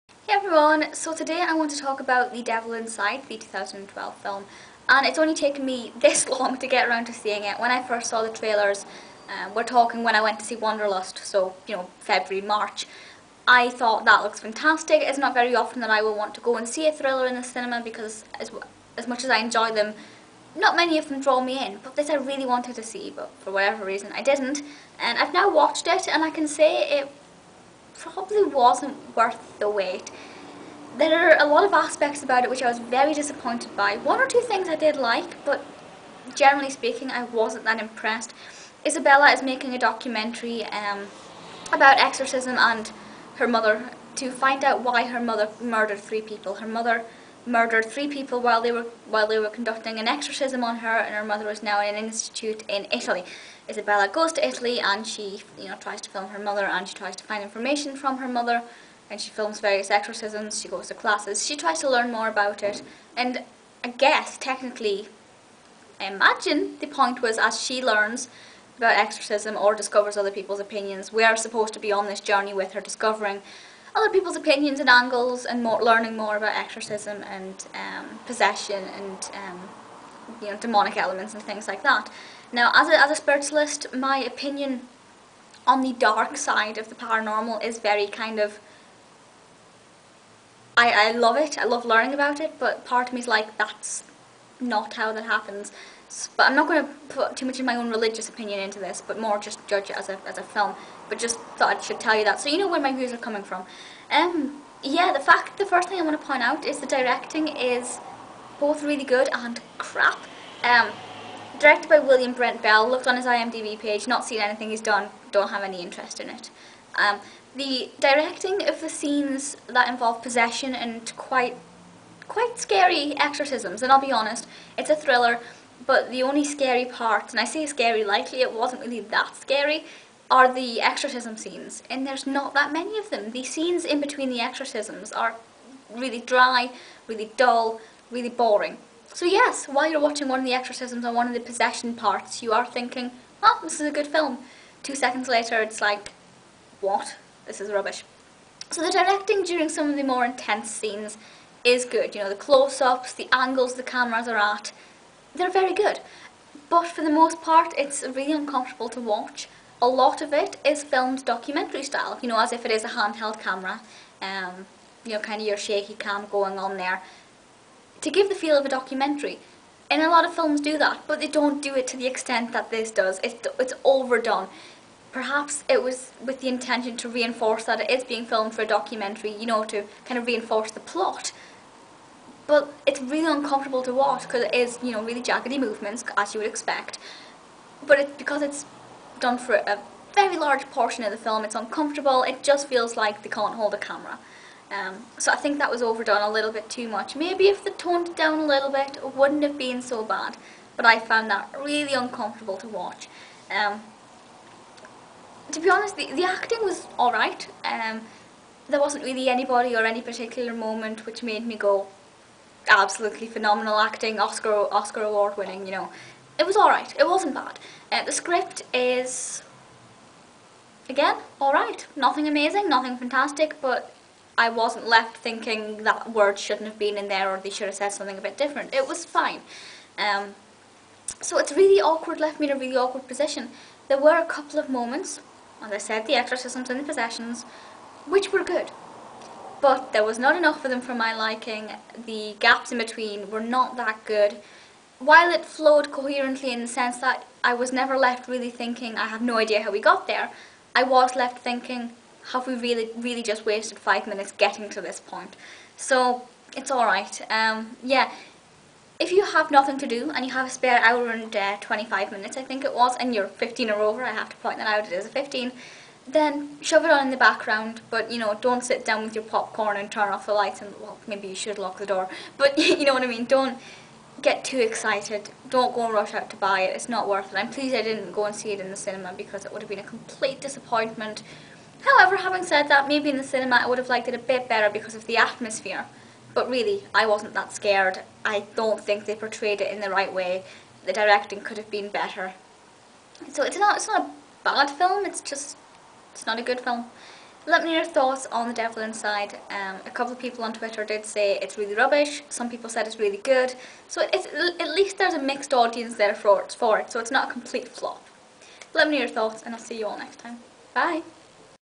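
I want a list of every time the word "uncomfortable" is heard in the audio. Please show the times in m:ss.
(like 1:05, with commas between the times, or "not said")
2:38, 3:03, 3:11, 3:21.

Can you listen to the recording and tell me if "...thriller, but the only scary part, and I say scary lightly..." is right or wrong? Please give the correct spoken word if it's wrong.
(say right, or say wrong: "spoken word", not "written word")
right.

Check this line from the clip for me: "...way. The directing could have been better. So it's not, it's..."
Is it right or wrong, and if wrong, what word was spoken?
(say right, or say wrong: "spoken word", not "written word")
right.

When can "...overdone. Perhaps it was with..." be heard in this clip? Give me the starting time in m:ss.
2:53.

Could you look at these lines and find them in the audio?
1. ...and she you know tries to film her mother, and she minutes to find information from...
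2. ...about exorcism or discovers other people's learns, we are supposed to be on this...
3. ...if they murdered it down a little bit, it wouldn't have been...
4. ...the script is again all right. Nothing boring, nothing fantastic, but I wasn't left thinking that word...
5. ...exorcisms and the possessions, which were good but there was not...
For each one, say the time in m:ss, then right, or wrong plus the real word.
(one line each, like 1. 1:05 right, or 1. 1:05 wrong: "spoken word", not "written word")
1. 0:54 wrong: "tries", not "minutes"
2. 1:08 wrong: "opinions", not "learns"
3. 3:17 wrong: "toned", not "murdered"
4. 3:38 wrong: "amazing", not "boring"
5. 3:56 right.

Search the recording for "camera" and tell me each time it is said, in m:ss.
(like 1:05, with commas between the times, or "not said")
2:33, 2:43, 3:13.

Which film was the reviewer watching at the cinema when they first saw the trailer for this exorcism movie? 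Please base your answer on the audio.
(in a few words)
Wanderlust.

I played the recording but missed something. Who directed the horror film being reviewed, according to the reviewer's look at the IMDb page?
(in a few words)
William Brent Bell.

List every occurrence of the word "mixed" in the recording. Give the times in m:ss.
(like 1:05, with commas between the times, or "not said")
5:05.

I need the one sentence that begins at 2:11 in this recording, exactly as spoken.
And there's not that many of them.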